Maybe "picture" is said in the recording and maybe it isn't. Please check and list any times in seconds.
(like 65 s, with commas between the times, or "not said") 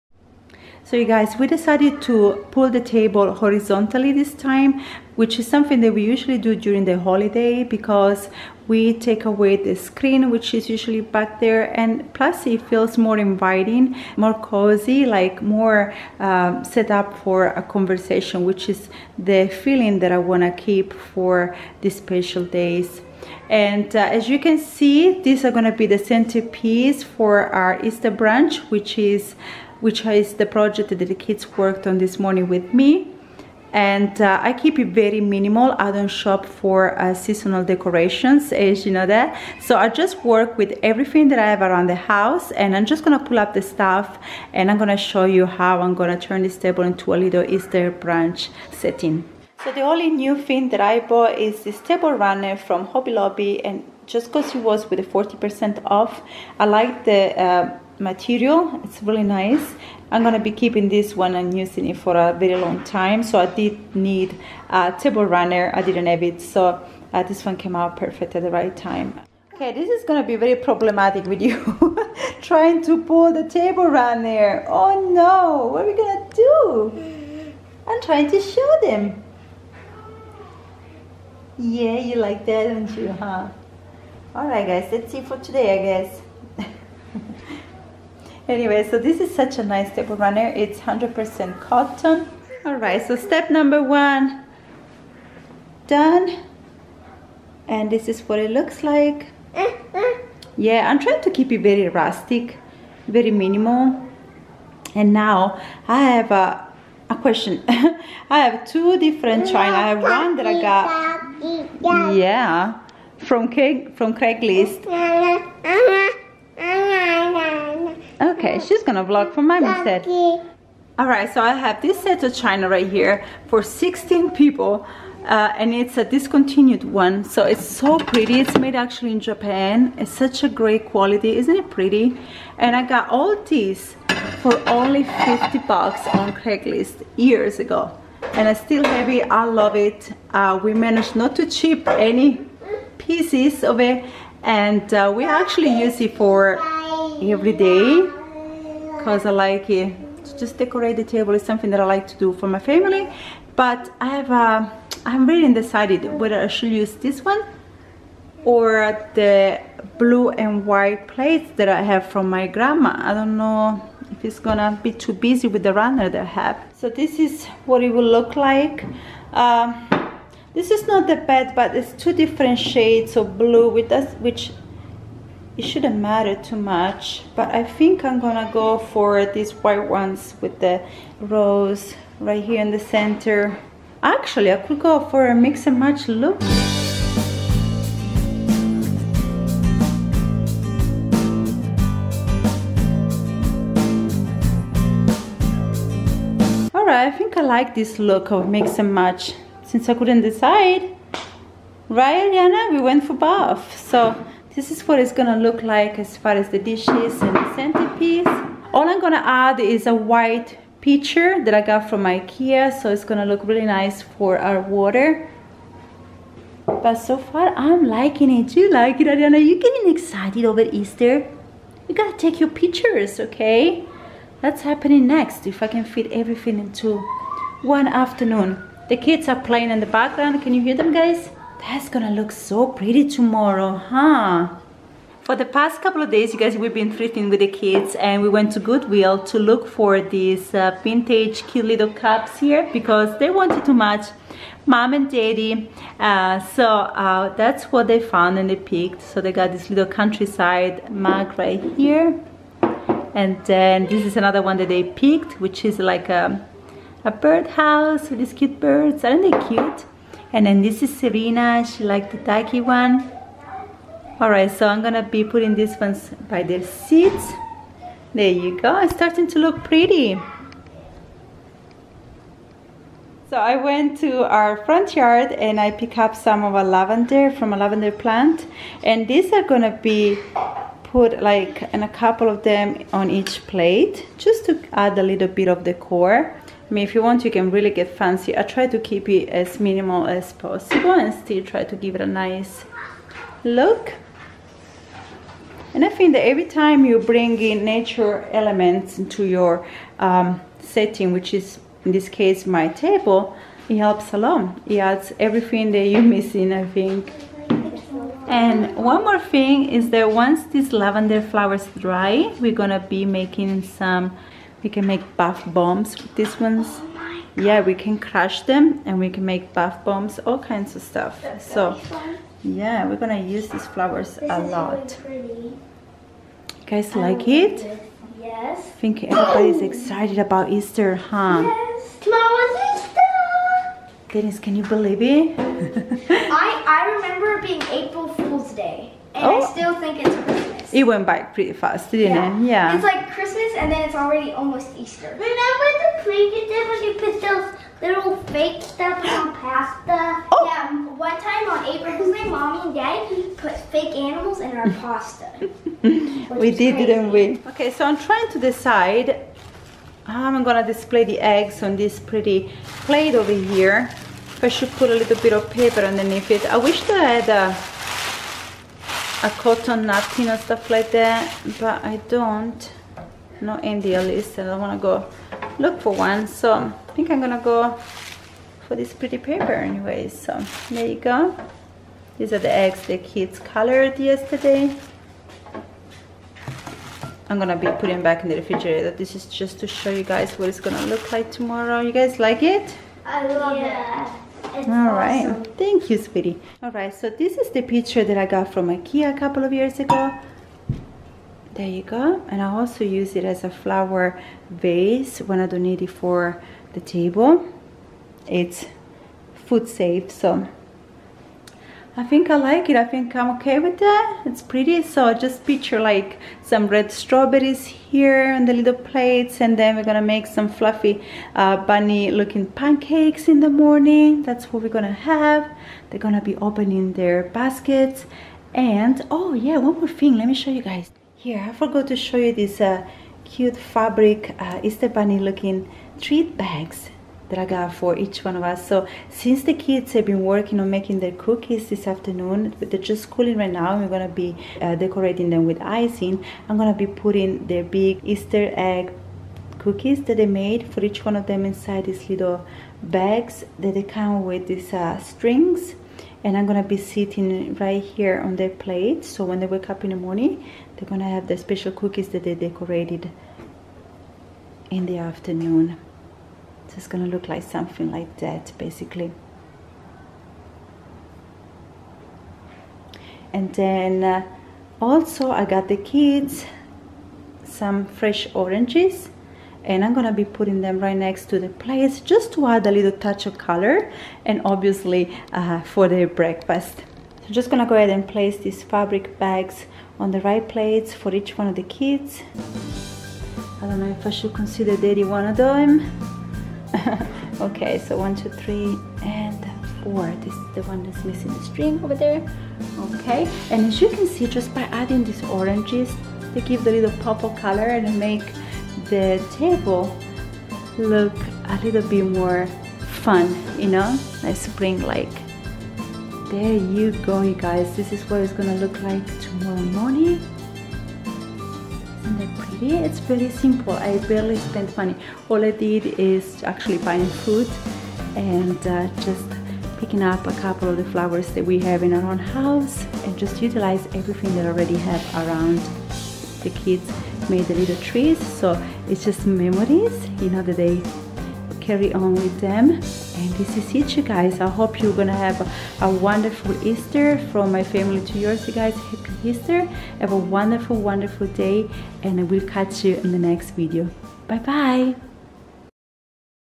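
222 s, 397 s, 415 s.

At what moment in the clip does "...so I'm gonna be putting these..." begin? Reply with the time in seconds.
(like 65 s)
264 s.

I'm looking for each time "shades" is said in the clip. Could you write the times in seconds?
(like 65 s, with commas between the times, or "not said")
172 s.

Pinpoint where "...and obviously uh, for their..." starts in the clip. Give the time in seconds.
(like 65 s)
484 s.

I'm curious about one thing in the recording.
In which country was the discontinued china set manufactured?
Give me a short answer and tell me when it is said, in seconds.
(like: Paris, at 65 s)
Japan, at 129 s.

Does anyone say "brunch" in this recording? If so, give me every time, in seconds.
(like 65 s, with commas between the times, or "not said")
28 s, 47 s.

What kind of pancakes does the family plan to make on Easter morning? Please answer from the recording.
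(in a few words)
bunny looking pancakes.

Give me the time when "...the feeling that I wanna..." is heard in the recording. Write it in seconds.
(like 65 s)
19 s.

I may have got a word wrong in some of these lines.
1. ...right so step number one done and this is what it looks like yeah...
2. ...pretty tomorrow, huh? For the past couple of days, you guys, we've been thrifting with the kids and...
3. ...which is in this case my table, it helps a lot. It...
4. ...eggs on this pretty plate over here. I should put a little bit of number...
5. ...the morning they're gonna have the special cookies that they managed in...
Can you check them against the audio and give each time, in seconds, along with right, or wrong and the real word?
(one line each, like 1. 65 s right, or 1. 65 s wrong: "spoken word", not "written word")
1. 92 s right
2. 232 s right
3. 301 s right
4. 361 s wrong: "paper", not "number"
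5. 459 s wrong: "decorated", not "managed".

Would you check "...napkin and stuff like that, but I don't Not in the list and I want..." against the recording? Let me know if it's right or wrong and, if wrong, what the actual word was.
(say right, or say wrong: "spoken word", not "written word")
right.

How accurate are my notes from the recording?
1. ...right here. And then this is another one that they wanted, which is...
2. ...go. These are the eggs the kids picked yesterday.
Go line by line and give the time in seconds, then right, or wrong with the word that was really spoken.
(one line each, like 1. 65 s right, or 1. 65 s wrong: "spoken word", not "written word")
1. 251 s wrong: "picked", not "wanted"
2. 380 s wrong: "colored", not "picked".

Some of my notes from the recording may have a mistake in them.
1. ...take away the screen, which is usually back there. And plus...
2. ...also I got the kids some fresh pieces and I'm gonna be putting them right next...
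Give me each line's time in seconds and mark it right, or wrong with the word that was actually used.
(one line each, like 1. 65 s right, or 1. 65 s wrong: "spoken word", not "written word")
1. 8 s right
2. 474 s wrong: "oranges", not "pieces".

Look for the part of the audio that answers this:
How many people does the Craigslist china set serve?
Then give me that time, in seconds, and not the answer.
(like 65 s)
123 s.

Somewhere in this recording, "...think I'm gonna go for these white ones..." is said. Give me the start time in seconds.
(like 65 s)
177 s.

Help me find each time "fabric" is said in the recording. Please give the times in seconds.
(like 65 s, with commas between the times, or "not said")
433 s, 488 s.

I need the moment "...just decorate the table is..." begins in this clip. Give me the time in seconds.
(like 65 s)
150 s.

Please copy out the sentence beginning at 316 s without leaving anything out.
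Oh yeah, we can crush them and we can make bath bombs, all kinds of stuff.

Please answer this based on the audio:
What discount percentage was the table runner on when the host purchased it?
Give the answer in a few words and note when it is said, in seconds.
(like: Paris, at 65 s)
40%, at 55 s.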